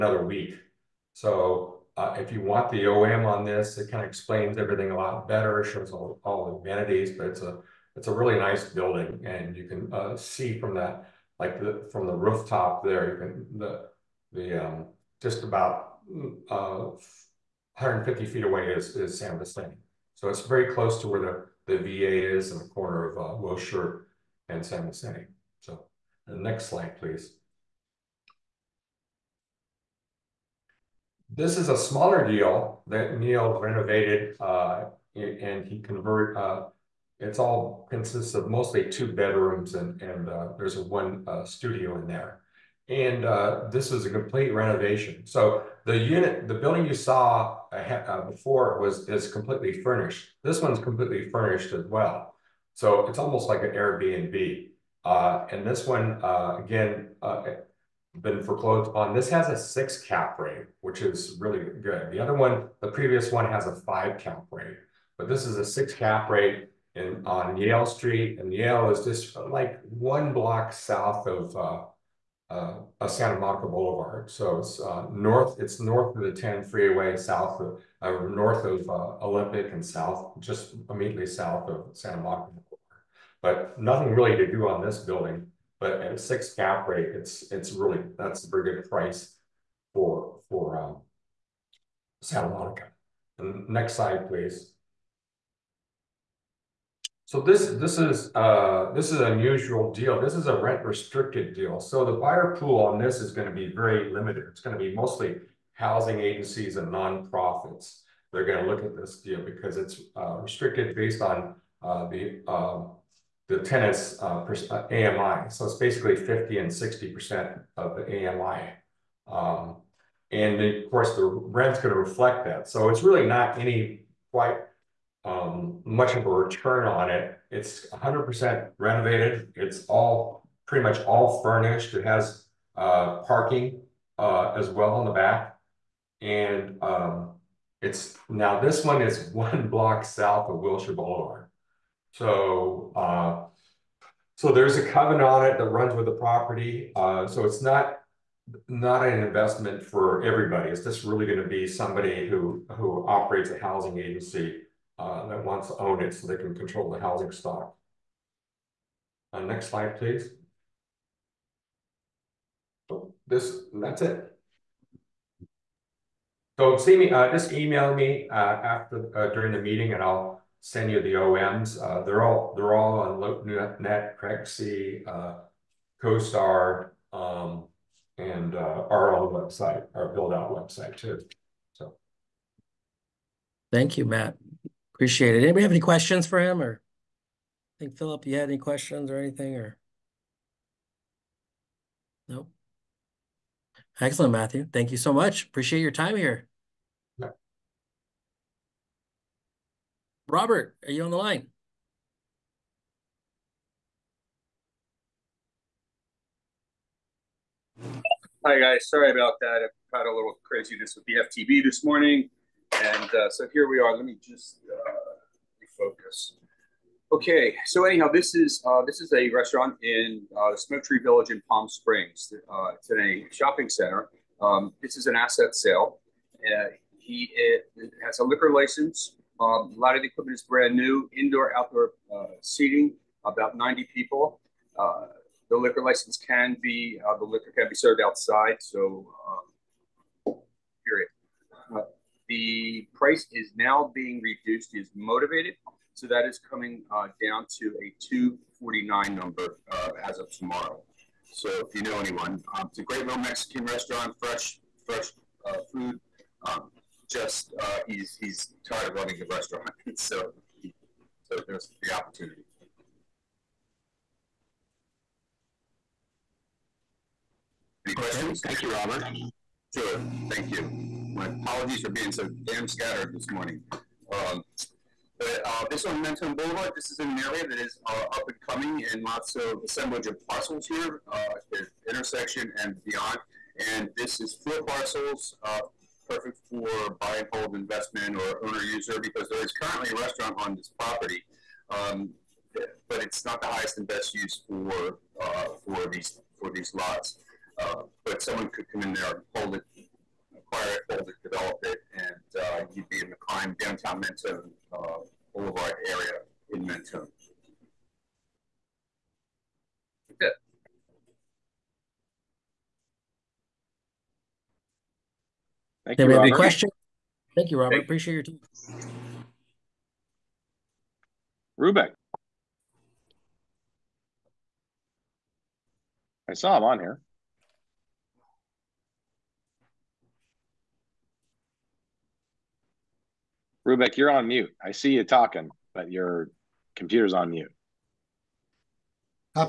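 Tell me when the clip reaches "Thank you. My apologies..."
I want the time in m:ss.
4:30.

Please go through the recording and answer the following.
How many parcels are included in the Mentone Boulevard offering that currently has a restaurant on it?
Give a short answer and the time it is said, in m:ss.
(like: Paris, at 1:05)
4, at 4:44.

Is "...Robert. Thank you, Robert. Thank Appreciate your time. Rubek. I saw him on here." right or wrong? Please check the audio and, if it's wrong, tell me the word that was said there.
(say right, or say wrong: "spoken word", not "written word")
right.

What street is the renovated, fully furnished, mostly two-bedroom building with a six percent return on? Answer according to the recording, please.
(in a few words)
Yale Street.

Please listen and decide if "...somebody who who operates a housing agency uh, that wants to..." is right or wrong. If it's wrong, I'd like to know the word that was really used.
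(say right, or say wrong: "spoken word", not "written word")
right.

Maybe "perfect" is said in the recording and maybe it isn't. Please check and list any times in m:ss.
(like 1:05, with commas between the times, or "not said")
4:46.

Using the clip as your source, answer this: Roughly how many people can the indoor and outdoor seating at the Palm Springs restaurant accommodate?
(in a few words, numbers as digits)
90.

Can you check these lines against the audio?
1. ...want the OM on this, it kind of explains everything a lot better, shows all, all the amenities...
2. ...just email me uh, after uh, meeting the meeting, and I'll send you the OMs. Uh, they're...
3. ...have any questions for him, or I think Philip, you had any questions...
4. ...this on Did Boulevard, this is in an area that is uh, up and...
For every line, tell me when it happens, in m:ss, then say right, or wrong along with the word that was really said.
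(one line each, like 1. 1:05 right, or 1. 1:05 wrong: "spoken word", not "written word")
1. 0:02 right
2. 2:47 wrong: "during", not "meeting"
3. 3:05 right
4. 4:35 wrong: "Mentone", not "Did".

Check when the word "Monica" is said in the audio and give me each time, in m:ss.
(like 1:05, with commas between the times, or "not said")
1:13, 1:22, 1:32.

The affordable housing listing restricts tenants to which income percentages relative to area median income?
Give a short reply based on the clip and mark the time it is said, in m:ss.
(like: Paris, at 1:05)
50 and 60%, at 1:56.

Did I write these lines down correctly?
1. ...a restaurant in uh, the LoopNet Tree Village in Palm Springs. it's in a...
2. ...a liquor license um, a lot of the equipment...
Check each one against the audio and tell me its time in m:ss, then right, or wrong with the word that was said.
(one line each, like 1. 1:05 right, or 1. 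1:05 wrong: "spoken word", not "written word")
1. 3:39 wrong: "Smoke", not "LoopNet"
2. 3:48 right.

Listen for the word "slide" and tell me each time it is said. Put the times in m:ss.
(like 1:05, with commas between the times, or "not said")
0:26, 1:33, 2:39.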